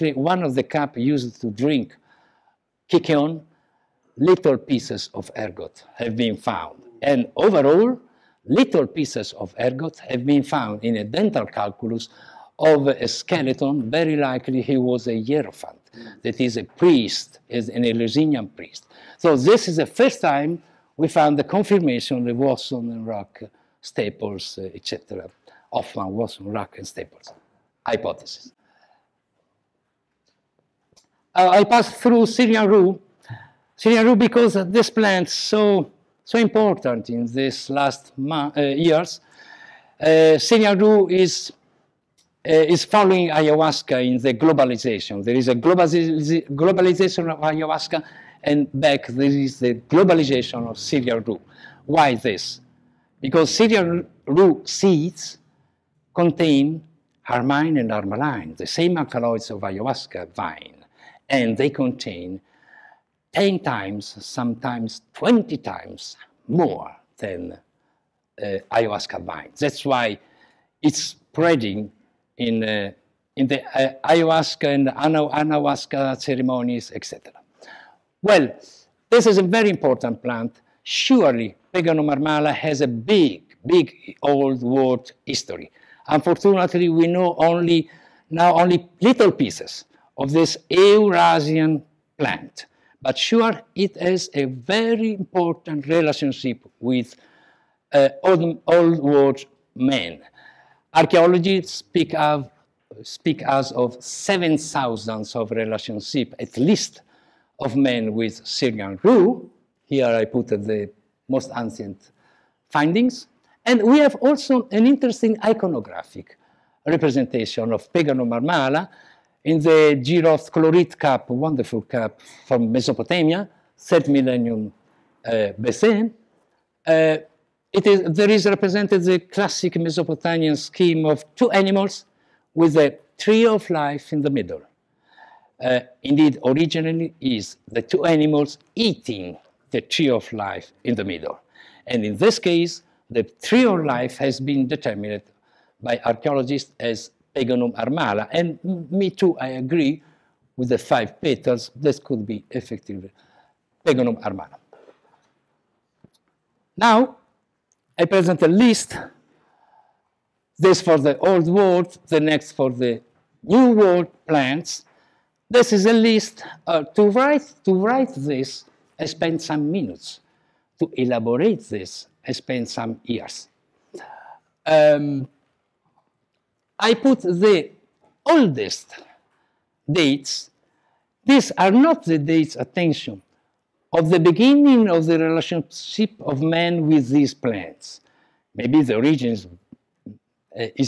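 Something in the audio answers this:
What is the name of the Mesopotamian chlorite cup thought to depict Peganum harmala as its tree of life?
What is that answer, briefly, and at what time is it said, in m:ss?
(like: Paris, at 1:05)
Jiroft, at 2:00.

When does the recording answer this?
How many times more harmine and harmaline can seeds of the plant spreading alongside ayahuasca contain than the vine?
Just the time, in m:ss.
1:05.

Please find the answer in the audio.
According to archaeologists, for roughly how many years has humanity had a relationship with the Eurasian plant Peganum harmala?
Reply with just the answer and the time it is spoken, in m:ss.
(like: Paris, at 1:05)
7,000 years, at 1:44.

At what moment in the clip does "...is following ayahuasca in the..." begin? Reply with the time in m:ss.
0:42.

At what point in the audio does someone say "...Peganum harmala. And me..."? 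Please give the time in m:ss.
2:27.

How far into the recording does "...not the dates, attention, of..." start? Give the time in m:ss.
3:01.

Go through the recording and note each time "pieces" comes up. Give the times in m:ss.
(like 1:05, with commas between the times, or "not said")
0:04, 0:08, 1:29.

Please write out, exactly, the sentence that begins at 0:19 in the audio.
So this is the first time we found the confirmation the Wasson and Ruck staples, etc.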